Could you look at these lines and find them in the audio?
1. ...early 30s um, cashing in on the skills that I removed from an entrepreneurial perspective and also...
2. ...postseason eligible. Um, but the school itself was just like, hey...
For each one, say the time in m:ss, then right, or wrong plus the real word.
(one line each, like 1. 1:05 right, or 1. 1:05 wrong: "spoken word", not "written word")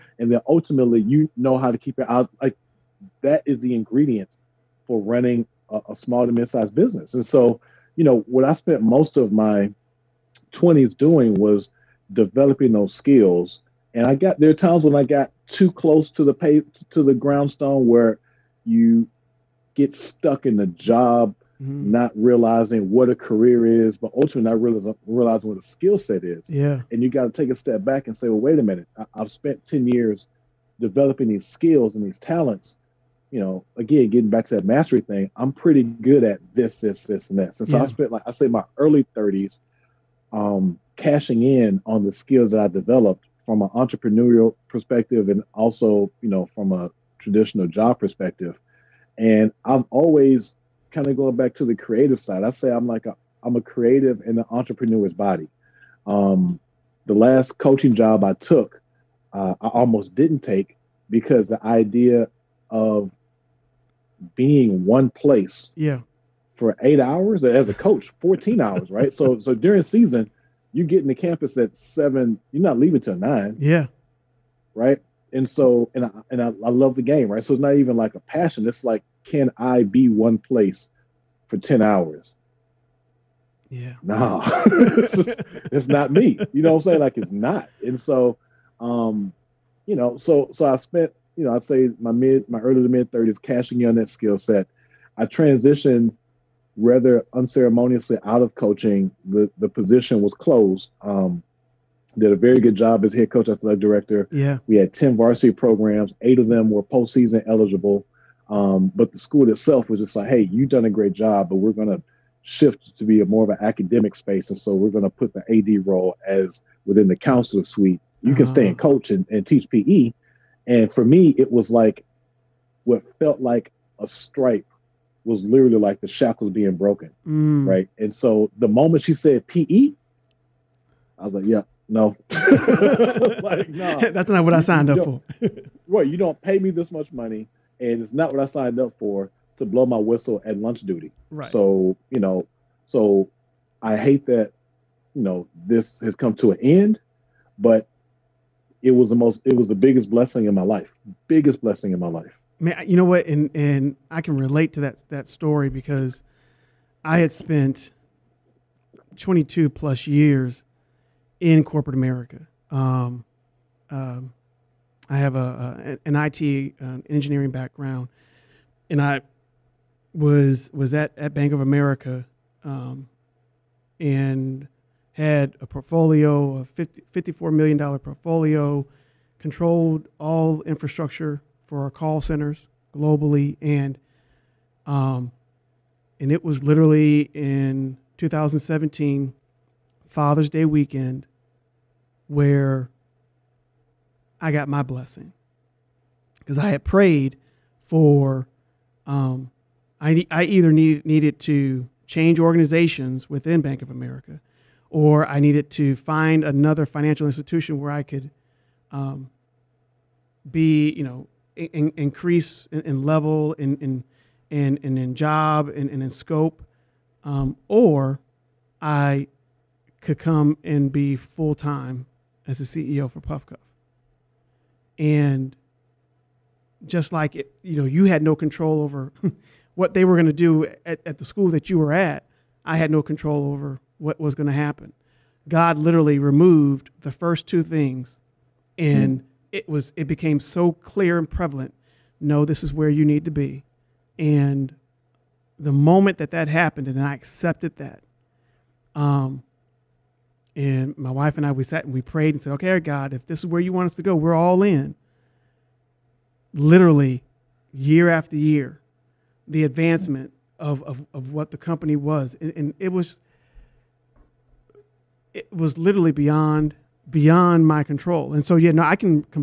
1. 0:38 wrong: "developed", not "removed"
2. 1:46 right.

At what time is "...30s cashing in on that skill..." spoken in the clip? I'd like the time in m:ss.
1:33.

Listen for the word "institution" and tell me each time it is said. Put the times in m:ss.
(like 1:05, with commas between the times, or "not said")
3:27.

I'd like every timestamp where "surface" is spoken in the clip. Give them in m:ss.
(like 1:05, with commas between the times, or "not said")
not said.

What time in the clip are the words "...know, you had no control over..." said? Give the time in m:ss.
3:47.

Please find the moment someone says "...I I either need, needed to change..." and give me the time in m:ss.
3:20.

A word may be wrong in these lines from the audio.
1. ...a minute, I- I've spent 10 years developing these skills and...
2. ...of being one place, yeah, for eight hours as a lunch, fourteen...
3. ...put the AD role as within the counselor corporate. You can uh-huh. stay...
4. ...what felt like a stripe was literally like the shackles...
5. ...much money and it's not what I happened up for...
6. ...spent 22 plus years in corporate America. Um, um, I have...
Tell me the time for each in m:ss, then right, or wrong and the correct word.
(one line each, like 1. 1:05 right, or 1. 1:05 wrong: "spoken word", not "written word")
1. 0:28 right
2. 1:02 wrong: "coach", not "lunch"
3. 1:55 wrong: "suite", not "corporate"
4. 2:02 right
5. 2:16 wrong: "signed", not "happened"
6. 2:37 right.